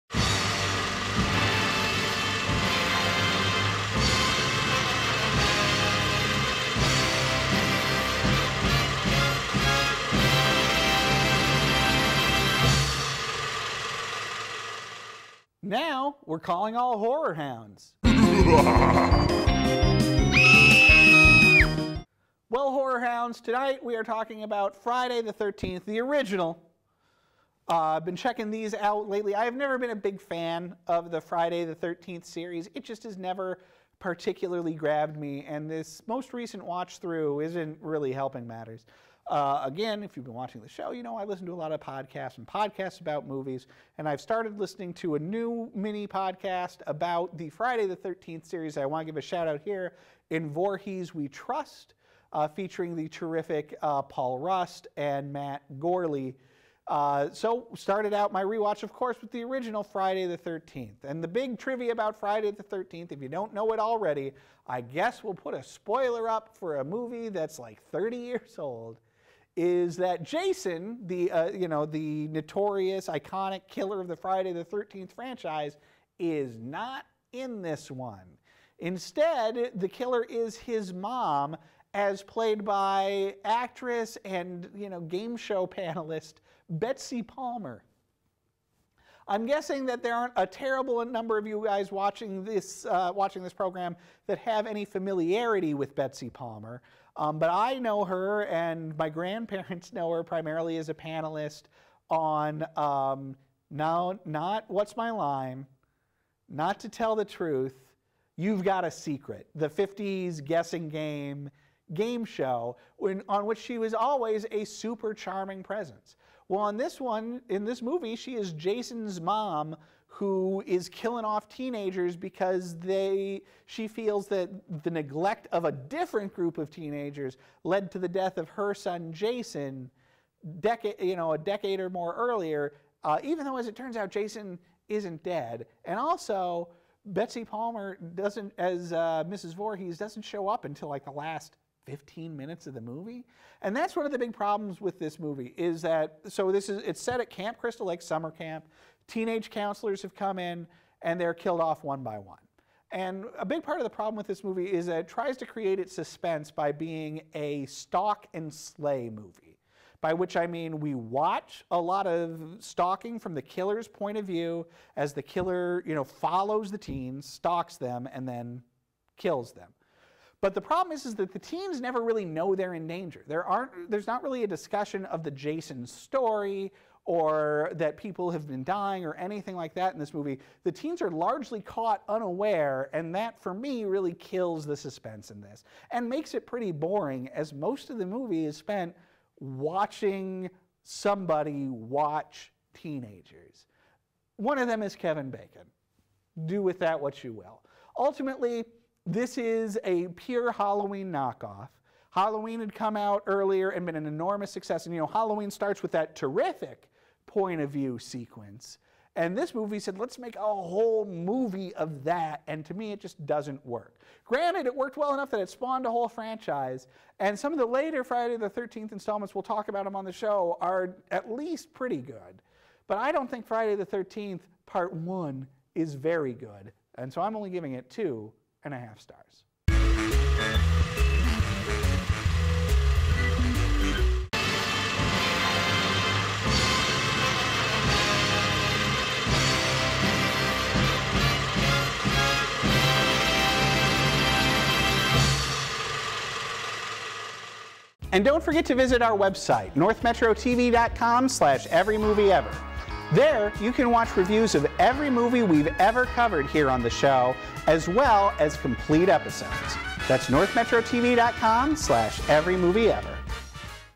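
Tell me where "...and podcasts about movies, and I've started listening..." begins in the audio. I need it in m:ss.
0:42.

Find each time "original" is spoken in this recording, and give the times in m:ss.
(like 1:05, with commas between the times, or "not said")
0:26, 0:59.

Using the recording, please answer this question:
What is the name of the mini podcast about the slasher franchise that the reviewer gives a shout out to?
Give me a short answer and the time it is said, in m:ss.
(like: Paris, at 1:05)
In Voorhees We Trust, at 0:50.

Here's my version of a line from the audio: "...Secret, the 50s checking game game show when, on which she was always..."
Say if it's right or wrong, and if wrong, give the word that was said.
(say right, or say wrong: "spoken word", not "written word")
wrong: "guessing", not "checking".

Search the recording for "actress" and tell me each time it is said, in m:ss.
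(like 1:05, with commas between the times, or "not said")
1:23.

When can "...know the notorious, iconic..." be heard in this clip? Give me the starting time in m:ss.
1:11.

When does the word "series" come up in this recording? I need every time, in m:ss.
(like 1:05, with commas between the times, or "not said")
0:32, 0:48.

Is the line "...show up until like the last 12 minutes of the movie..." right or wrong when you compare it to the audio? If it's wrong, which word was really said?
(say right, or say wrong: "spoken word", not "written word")
wrong: "15", not "12".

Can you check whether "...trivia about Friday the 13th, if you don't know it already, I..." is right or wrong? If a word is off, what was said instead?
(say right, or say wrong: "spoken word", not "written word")
right.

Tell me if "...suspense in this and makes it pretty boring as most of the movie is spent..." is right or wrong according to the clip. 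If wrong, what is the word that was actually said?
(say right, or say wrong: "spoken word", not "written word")
right.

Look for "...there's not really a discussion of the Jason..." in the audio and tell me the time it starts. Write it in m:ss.
2:53.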